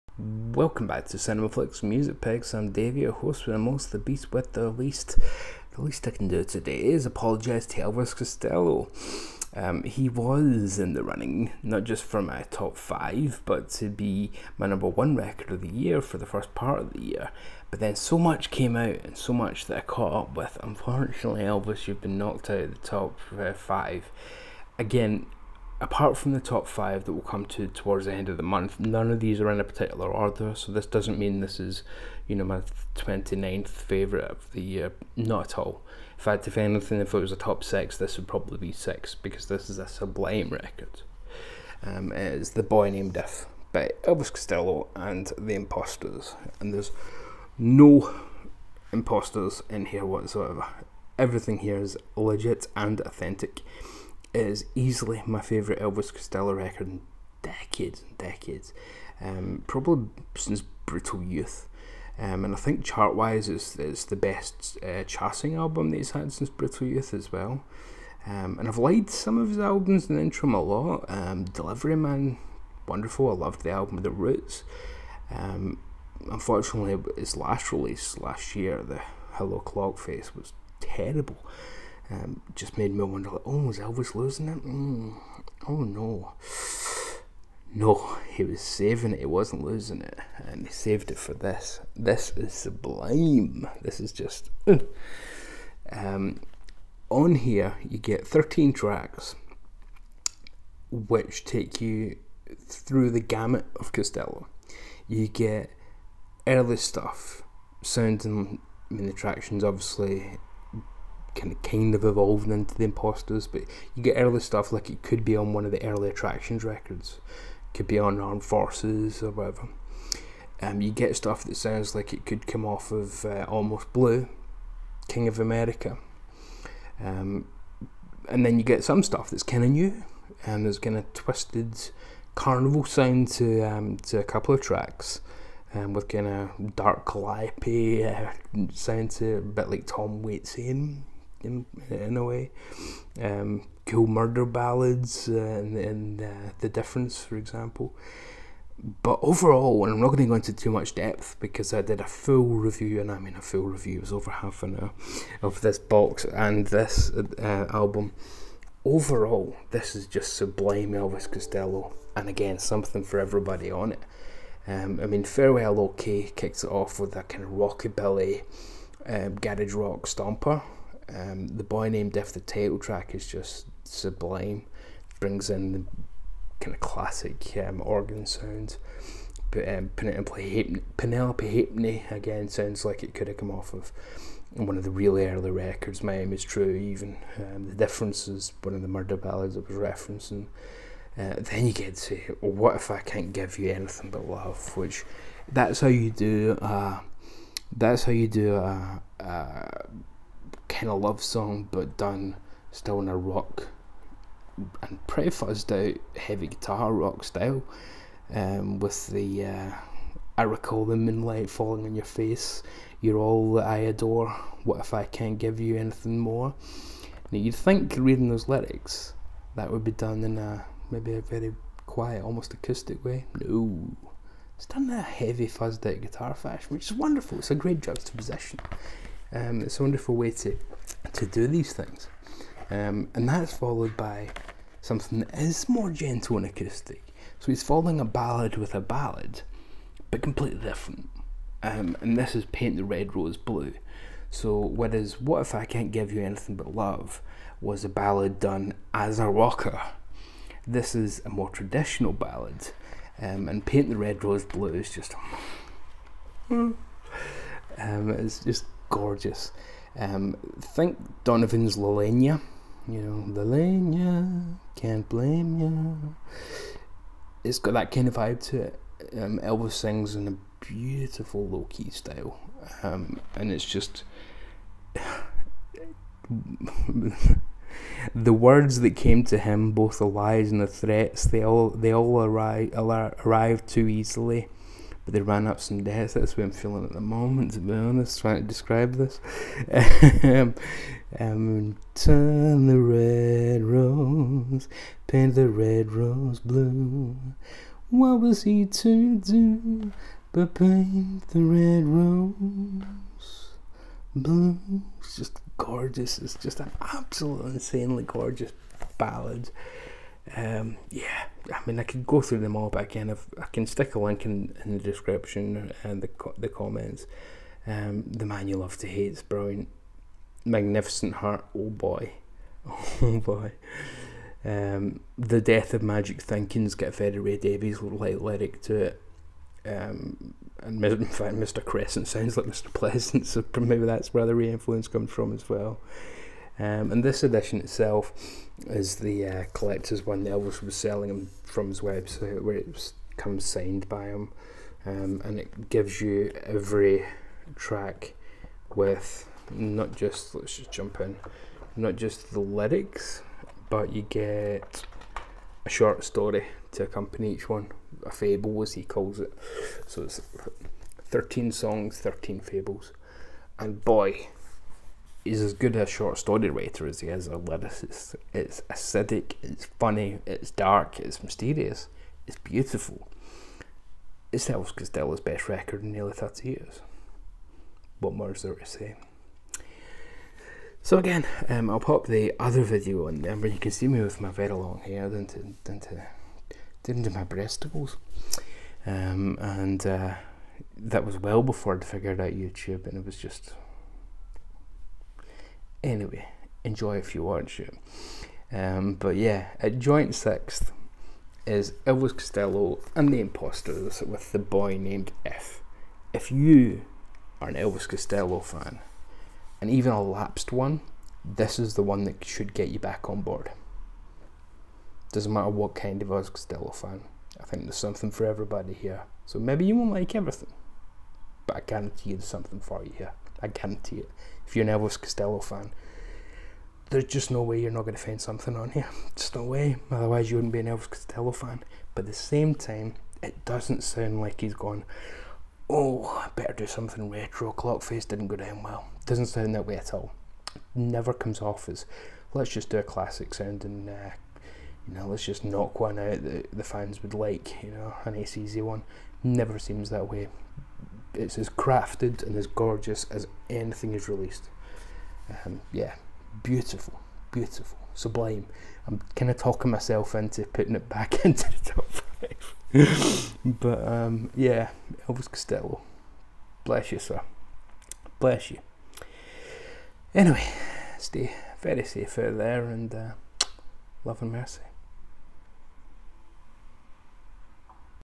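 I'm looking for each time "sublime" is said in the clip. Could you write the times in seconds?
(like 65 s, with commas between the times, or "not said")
39 s, 92 s, 160 s, 173 s, 457 s.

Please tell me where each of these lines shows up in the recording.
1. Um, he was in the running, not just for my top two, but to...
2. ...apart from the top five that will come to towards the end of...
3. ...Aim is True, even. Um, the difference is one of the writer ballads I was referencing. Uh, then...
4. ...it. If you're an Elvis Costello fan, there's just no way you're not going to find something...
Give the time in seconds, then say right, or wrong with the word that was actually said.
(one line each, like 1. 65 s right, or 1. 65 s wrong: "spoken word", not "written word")
1. 9 s wrong: "five", not "two"
2. 25 s right
3. 186 s wrong: "murder", not "writer"
4. 423 s right.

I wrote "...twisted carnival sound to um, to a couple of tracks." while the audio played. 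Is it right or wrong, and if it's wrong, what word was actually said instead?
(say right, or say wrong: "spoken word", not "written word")
right.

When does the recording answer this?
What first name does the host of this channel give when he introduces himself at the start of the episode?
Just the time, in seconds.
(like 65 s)
2 s.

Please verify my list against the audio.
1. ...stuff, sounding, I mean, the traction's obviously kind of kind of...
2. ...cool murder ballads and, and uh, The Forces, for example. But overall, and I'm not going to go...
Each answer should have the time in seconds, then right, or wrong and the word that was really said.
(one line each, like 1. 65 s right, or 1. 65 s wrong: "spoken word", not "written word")
1. 106 s right
2. 143 s wrong: "Difference", not "Forces".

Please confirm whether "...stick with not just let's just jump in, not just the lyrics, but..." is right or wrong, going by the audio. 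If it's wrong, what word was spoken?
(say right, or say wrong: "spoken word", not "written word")
wrong: "track", not "stick".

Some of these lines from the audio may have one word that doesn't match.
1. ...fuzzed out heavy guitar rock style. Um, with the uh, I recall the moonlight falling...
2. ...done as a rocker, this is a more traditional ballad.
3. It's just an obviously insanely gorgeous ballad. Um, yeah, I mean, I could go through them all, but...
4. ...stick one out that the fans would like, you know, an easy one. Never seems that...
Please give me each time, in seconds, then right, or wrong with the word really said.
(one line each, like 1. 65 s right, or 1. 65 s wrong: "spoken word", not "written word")
1. 205 s right
2. 248 s right
3. 306 s wrong: "absolutely", not "obviously"
4. 445 s wrong: "knock", not "stick".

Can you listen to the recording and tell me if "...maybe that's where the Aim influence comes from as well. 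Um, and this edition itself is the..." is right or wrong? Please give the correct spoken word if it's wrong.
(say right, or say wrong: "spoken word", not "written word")
wrong: "Ray", not "Aim".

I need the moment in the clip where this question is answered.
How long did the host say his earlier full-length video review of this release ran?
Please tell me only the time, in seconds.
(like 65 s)
154 s.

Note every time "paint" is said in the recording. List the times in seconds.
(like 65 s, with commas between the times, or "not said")
242 s, 253 s, 295 s, 300 s.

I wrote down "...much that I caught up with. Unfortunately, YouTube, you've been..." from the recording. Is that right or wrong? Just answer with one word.
wrong.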